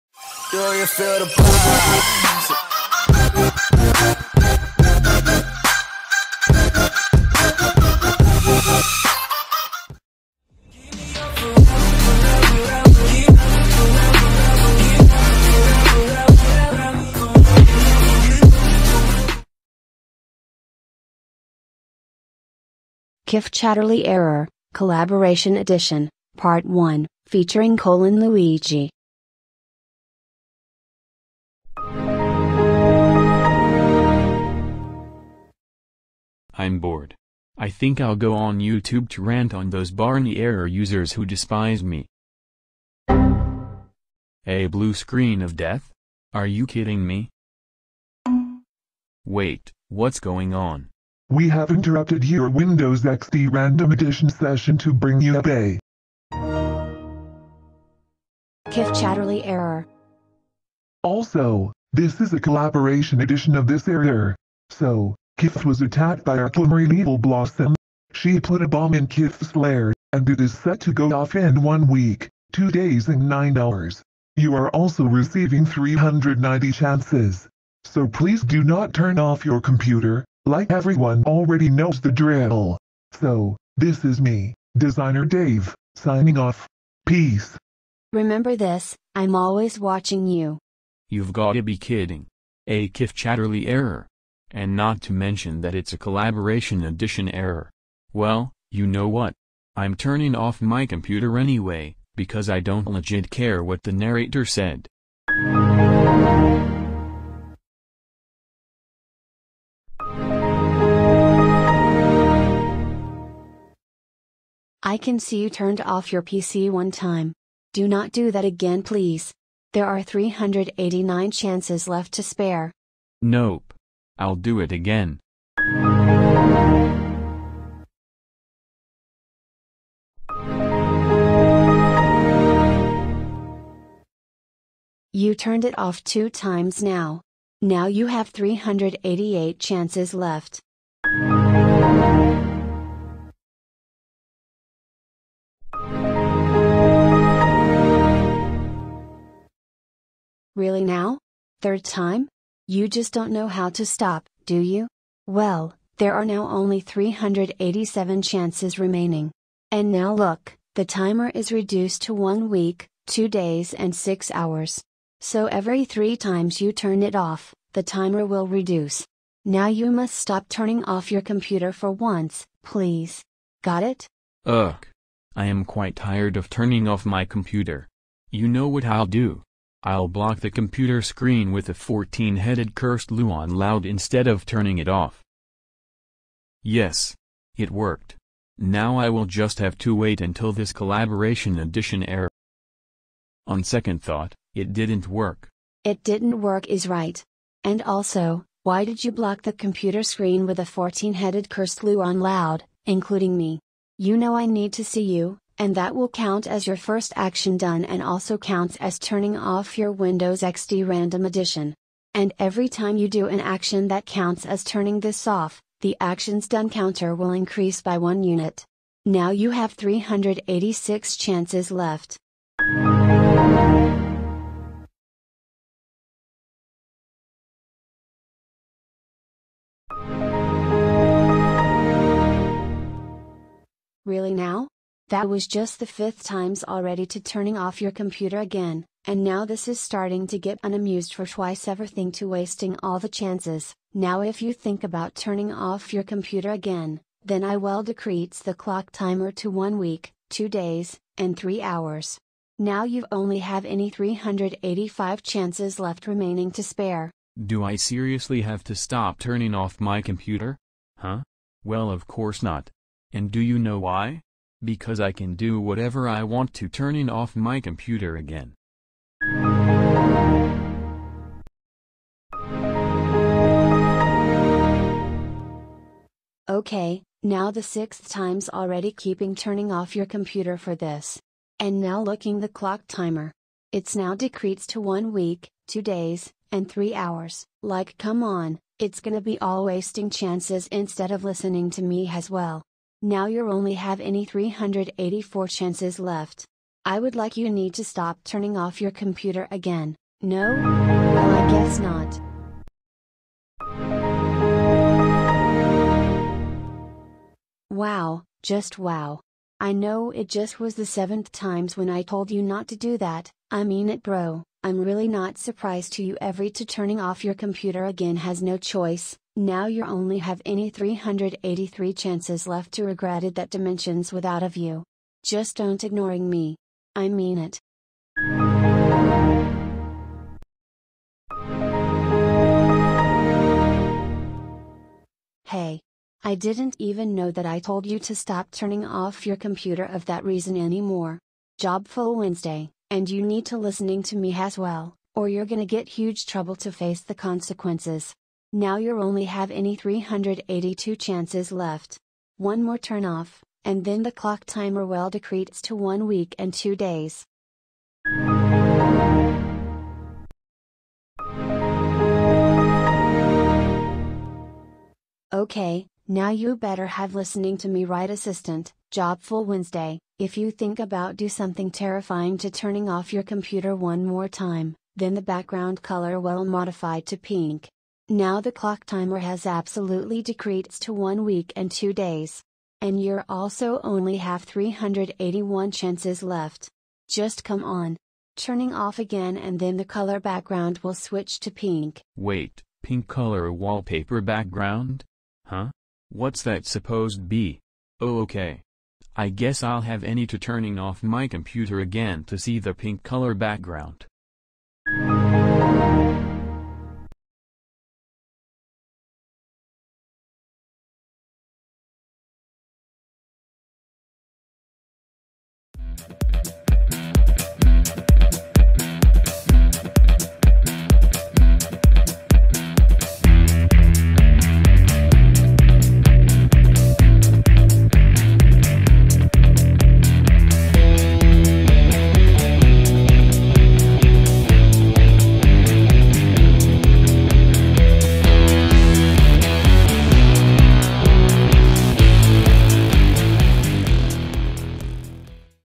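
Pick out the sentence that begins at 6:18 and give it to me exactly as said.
Now the clock timer has absolutely decreased to 1 week and 2 days.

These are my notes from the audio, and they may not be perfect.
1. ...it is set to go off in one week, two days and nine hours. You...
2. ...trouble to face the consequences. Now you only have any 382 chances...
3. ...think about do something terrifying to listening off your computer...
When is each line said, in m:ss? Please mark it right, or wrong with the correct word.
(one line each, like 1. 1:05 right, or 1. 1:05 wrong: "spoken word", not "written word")
1. 1:10 right
2. 5:46 right
3. 6:10 wrong: "turning", not "listening".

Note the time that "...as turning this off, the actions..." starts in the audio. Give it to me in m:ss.
3:34.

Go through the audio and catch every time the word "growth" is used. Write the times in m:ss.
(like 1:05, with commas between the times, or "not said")
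not said.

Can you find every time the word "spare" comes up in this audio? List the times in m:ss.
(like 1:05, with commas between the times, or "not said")
2:02, 4:16.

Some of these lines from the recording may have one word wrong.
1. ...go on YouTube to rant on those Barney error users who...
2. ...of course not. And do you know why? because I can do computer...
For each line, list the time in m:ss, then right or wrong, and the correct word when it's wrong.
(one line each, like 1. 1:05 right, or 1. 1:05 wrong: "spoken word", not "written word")
1. 0:38 right
2. 4:21 wrong: "whatever", not "computer".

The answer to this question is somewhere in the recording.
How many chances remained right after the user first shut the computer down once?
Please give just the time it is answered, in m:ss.
2:00.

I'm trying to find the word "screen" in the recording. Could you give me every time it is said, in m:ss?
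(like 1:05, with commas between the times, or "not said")
0:44, 3:01, 3:20.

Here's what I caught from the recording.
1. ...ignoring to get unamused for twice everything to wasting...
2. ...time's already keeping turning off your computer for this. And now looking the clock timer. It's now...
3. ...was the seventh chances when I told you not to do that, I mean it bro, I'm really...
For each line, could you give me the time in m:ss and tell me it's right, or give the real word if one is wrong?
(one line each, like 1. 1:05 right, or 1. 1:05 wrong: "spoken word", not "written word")
1. 3:59 wrong: "starting", not "ignoring"
2. 4:38 right
3. 5:10 wrong: "times", not "chances".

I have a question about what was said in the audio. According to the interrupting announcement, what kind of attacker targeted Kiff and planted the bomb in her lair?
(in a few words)
glimmering evil blossom.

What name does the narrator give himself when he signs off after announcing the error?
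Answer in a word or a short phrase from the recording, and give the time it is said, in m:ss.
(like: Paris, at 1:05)
Designer Dave, at 1:24.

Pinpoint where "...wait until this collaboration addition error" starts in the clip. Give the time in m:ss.
3:09.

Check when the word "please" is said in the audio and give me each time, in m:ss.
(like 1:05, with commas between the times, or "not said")
1:18, 1:58, 2:52.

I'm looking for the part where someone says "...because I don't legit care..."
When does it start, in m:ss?
1:42.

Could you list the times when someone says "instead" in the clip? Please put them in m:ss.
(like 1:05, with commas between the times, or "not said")
3:03, 4:50.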